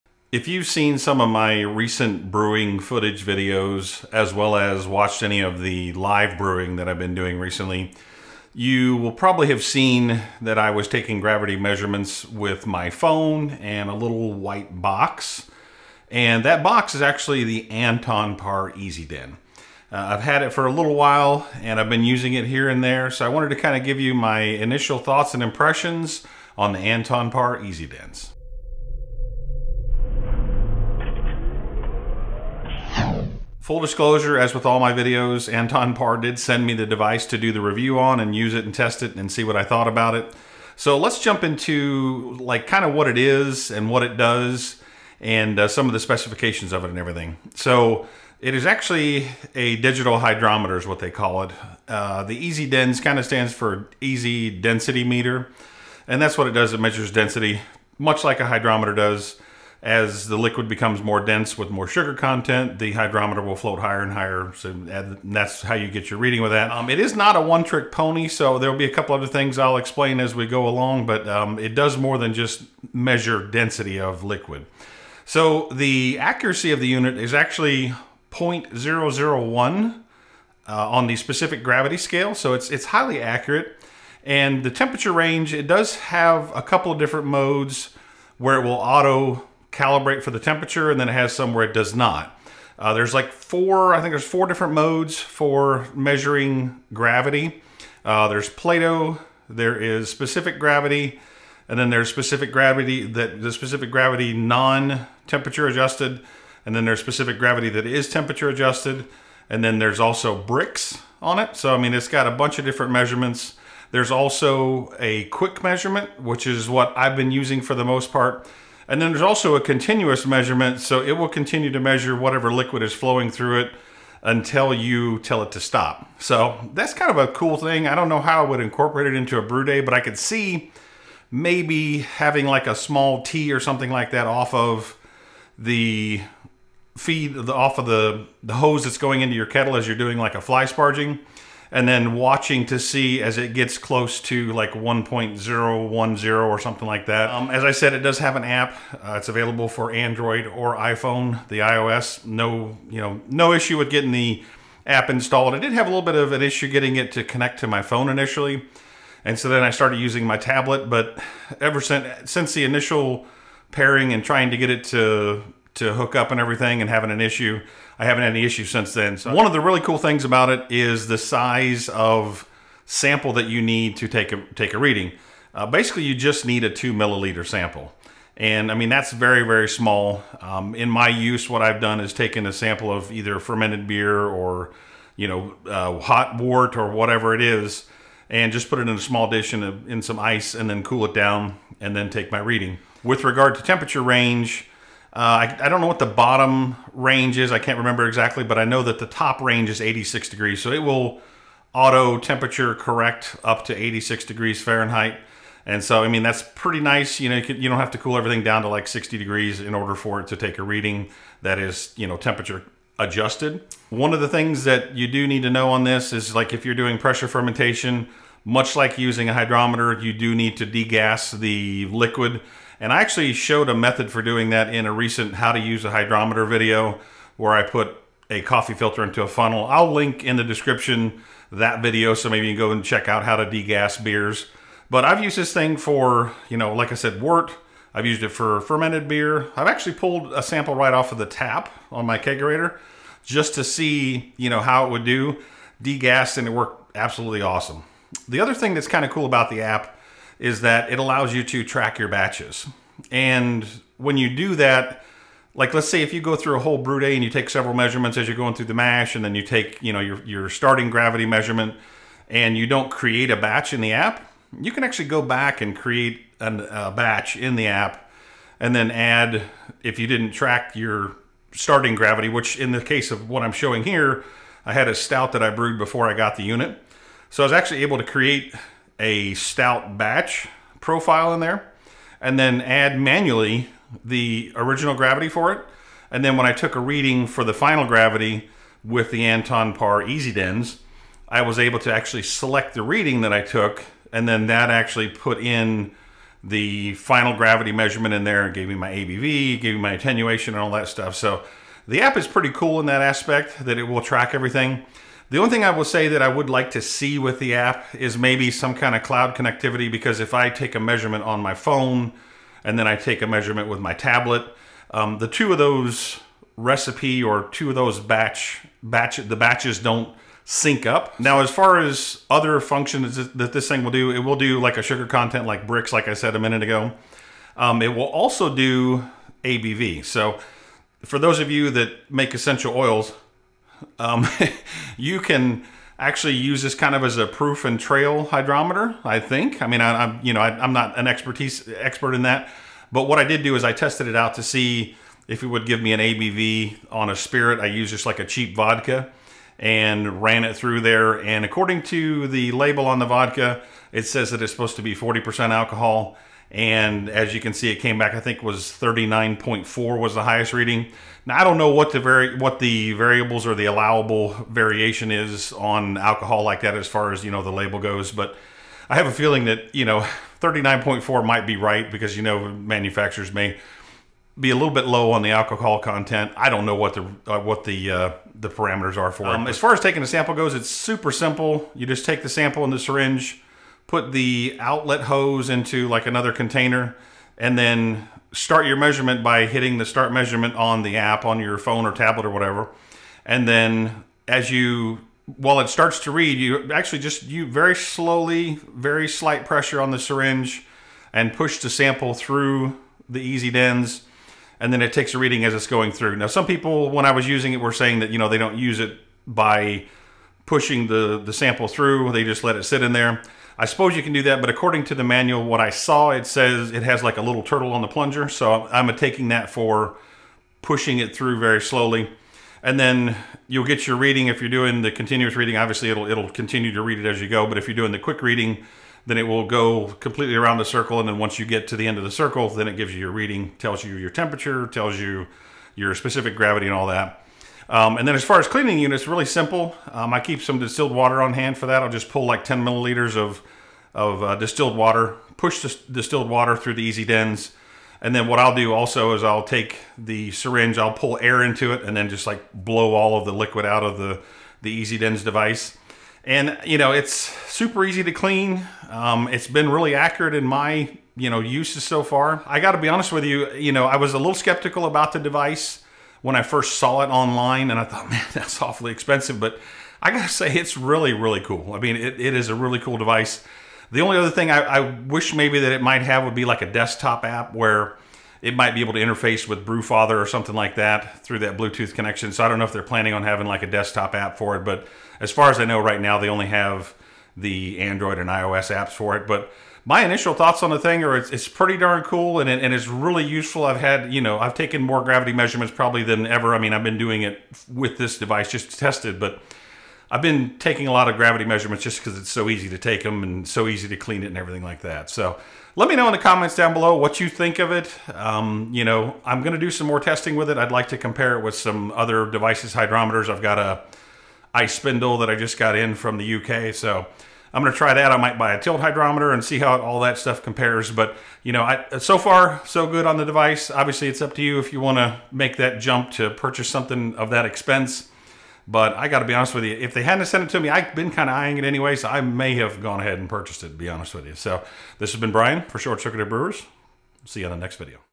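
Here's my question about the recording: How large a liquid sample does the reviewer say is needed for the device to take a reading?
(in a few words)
2 milliliters.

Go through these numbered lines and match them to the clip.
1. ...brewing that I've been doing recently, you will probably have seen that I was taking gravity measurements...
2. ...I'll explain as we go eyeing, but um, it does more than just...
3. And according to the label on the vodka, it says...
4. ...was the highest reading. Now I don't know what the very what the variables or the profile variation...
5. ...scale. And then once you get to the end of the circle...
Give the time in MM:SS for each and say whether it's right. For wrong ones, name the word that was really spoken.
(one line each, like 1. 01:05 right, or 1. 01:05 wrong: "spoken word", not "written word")
1. 00:06 right
2. 01:09 wrong: "along", not "eyeing"
3. 05:51 right
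4. 05:59 wrong: "allowable", not "profile"
5. 07:10 wrong: "circle", not "scale".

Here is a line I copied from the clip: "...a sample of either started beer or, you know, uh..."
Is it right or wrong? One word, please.
wrong.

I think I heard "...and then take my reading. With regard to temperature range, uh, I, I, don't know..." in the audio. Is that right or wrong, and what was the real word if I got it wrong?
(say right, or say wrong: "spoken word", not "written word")
right.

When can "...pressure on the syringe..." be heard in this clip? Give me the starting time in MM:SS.
06:39.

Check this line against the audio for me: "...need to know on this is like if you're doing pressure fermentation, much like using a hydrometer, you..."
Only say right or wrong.
right.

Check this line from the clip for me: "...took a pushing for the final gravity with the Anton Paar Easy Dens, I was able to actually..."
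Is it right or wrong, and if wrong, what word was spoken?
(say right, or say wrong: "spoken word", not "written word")
wrong: "reading", not "pushing".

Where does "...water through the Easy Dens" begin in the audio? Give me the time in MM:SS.
07:26.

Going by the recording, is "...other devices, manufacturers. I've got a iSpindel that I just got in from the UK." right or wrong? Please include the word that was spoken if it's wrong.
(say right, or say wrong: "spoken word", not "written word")
wrong: "hydrometers", not "manufacturers".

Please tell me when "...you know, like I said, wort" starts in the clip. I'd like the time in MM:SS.
03:56.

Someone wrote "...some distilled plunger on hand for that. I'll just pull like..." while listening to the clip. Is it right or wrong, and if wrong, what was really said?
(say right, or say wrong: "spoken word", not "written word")
wrong: "water", not "plunger".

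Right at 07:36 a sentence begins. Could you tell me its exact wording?
And you know, it's super easy to clean.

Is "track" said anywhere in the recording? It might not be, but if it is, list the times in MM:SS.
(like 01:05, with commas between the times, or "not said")
04:11, 04:30, 05:04.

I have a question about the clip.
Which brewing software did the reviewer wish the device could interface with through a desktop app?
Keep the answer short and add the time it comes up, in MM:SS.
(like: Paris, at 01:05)
Brewfather, at 07:59.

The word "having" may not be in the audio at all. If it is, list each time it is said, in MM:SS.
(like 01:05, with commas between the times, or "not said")
02:11, 02:46, 08:03.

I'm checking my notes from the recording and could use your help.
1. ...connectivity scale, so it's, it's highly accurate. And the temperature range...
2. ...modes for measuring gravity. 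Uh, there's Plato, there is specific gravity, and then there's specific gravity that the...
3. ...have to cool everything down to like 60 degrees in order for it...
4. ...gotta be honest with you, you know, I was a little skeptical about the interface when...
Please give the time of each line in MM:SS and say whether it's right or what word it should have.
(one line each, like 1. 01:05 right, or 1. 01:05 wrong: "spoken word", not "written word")
1. 01:21 wrong: "gravity", not "connectivity"
2. 01:34 right
3. 03:27 right
4. 07:42 wrong: "device", not "interface".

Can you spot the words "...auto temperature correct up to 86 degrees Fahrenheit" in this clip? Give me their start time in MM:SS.
03:21.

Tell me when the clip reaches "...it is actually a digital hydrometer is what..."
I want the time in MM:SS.
00:48.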